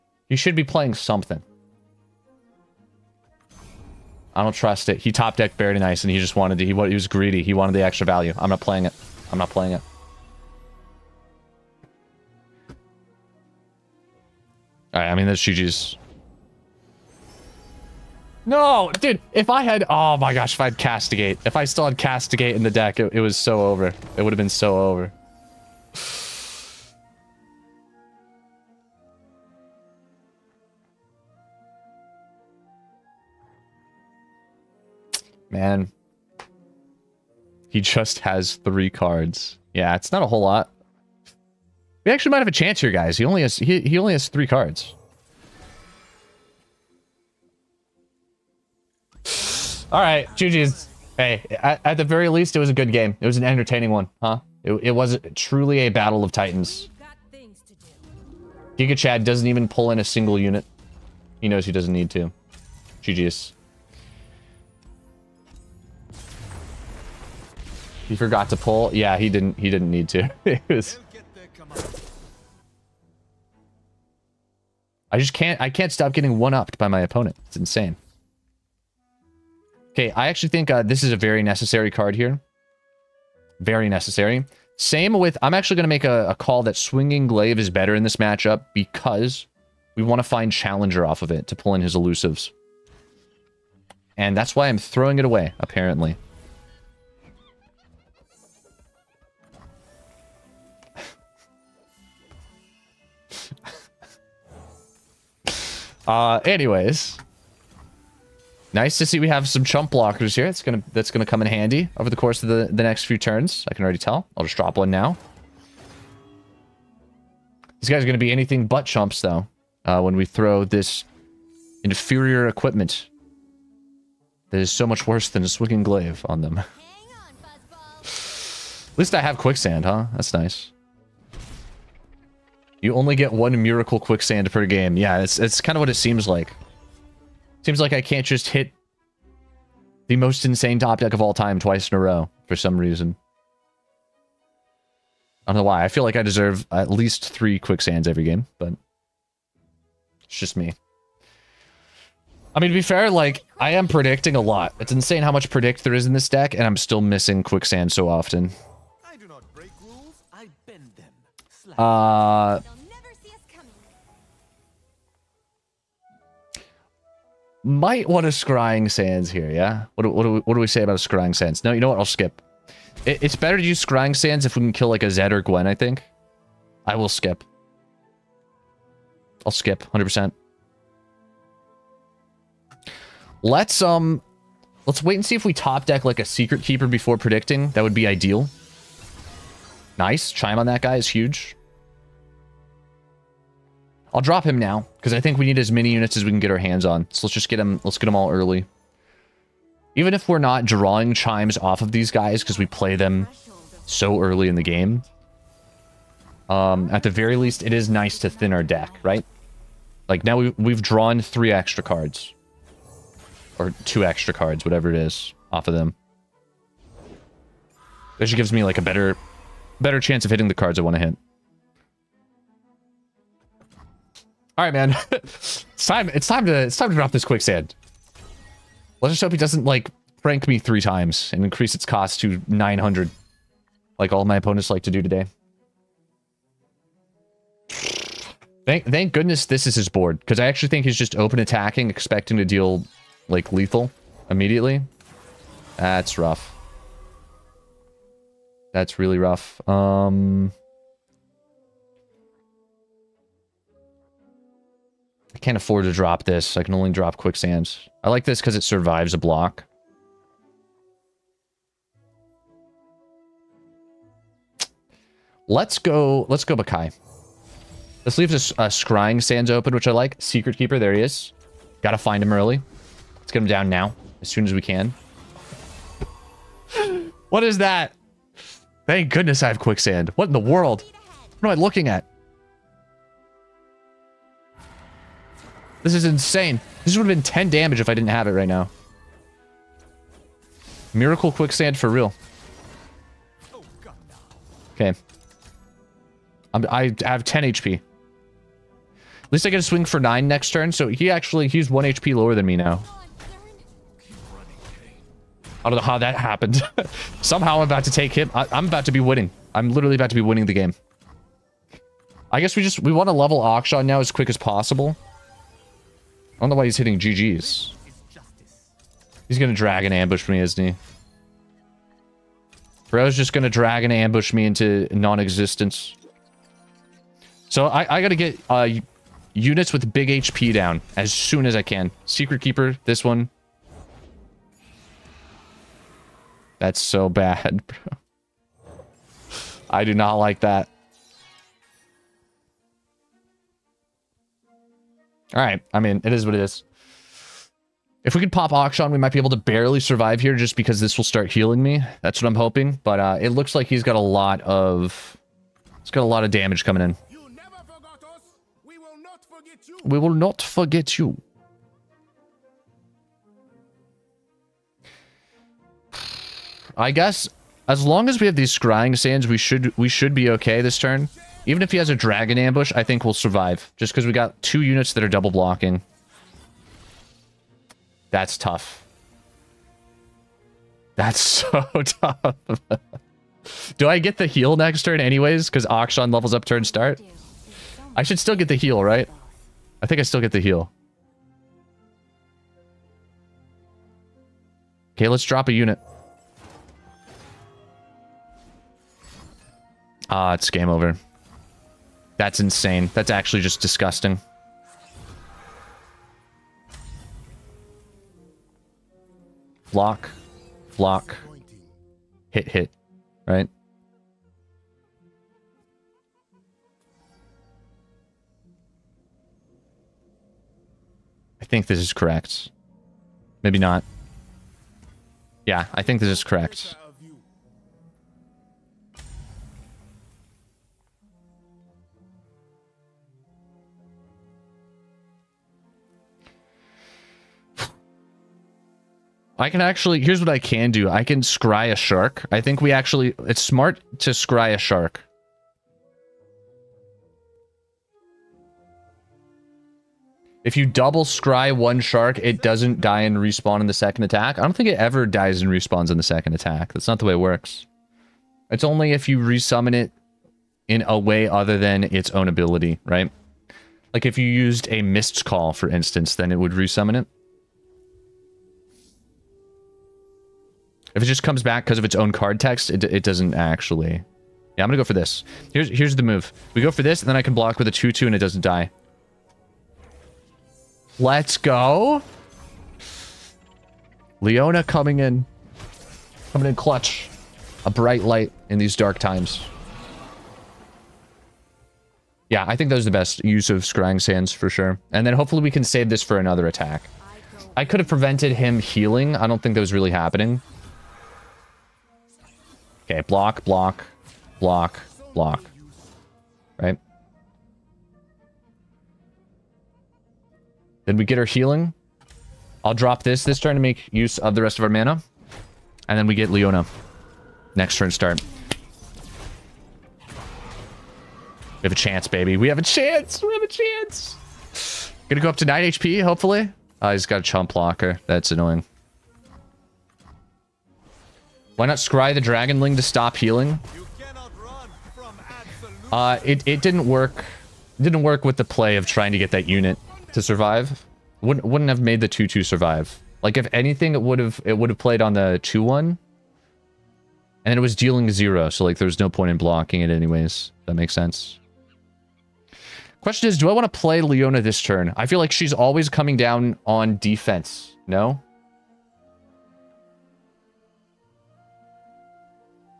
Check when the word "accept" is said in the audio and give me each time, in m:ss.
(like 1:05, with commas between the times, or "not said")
not said.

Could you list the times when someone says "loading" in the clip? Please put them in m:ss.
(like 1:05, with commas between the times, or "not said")
not said.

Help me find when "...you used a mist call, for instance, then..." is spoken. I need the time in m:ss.
7:44.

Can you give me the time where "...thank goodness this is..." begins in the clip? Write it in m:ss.
3:58.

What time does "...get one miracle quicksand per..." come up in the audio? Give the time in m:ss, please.
2:13.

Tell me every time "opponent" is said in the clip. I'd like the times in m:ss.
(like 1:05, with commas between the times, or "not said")
1:17, 3:54.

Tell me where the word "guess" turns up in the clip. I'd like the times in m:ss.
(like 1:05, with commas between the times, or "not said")
5:12, 6:06.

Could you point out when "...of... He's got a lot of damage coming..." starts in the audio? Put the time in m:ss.
5:54.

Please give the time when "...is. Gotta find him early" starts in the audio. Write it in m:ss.
4:31.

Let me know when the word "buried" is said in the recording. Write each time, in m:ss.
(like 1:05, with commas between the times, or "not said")
0:05.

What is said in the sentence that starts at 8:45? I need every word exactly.
Gonna go up to 9 HP, hopefully.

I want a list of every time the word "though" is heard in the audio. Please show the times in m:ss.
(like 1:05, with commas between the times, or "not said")
1:59.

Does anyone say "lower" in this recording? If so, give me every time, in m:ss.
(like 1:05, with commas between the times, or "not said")
5:02.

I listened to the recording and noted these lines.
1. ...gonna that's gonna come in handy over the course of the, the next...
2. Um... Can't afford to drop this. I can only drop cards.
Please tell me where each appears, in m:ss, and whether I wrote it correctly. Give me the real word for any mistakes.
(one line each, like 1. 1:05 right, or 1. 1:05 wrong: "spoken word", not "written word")
1. 1:50 right
2. 4:09 wrong: "quicksands", not "cards".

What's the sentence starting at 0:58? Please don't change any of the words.
Giga Chad doesn't even pull in a single unit.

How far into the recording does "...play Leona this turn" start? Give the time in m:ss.
9:13.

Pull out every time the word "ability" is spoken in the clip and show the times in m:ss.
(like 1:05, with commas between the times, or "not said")
7:42.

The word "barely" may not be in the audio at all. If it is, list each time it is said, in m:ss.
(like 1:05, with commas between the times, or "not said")
5:49.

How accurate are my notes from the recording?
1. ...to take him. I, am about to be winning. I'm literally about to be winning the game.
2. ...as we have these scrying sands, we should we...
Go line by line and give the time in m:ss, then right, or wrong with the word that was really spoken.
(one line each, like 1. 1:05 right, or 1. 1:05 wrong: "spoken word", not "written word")
1. 5:07 right
2. 6:08 right.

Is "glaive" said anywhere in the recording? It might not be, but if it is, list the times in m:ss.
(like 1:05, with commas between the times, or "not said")
1:27, 2:05.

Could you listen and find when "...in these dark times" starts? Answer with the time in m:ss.
8:08.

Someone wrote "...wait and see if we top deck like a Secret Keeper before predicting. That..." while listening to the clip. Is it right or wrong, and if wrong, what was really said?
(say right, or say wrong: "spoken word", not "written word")
right.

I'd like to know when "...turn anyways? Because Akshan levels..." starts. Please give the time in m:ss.
6:24.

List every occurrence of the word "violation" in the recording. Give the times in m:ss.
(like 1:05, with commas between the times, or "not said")
not said.